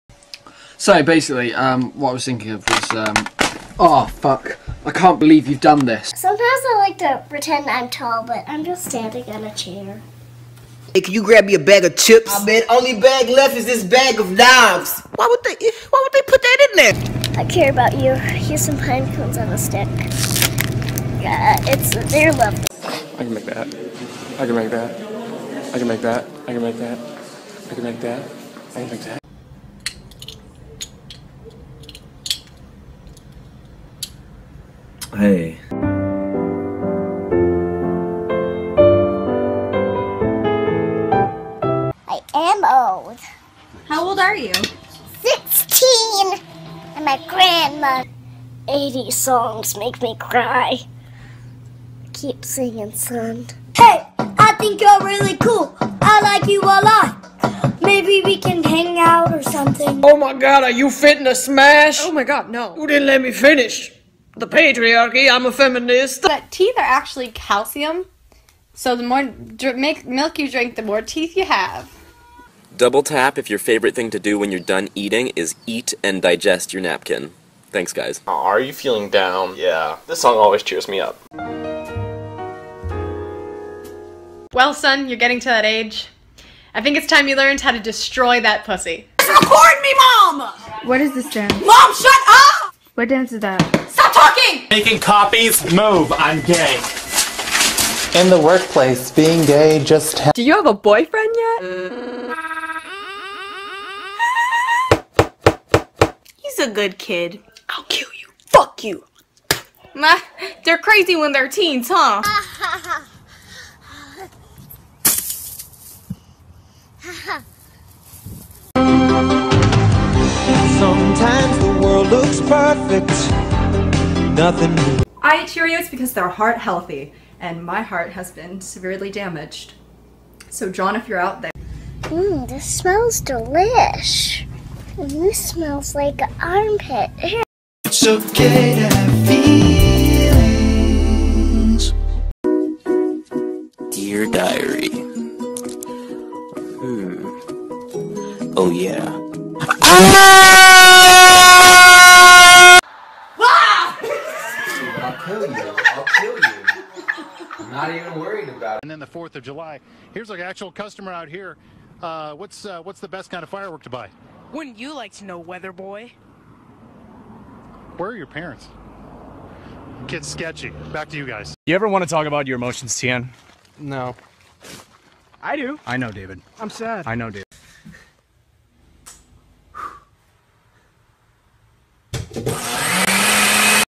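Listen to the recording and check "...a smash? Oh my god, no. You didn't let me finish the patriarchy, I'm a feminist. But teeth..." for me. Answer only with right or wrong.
right.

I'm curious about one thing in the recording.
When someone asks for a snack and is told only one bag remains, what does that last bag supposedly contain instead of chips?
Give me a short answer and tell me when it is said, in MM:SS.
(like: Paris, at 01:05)
knives, at 00:14.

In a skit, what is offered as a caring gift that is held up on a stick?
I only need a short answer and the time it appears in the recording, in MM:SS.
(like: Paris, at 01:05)
pine cones, at 00:18.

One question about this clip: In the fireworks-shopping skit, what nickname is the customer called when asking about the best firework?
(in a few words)
Weather Boy.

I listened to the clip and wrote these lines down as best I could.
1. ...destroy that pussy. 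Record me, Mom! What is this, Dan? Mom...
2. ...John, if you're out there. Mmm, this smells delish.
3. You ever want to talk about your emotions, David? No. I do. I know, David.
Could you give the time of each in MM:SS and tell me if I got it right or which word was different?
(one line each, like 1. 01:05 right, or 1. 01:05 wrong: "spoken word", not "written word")
1. 01:27 right
2. 02:10 right
3. 02:51 wrong: "Tian", not "David".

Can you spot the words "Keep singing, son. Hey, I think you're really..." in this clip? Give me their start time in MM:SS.
00:52.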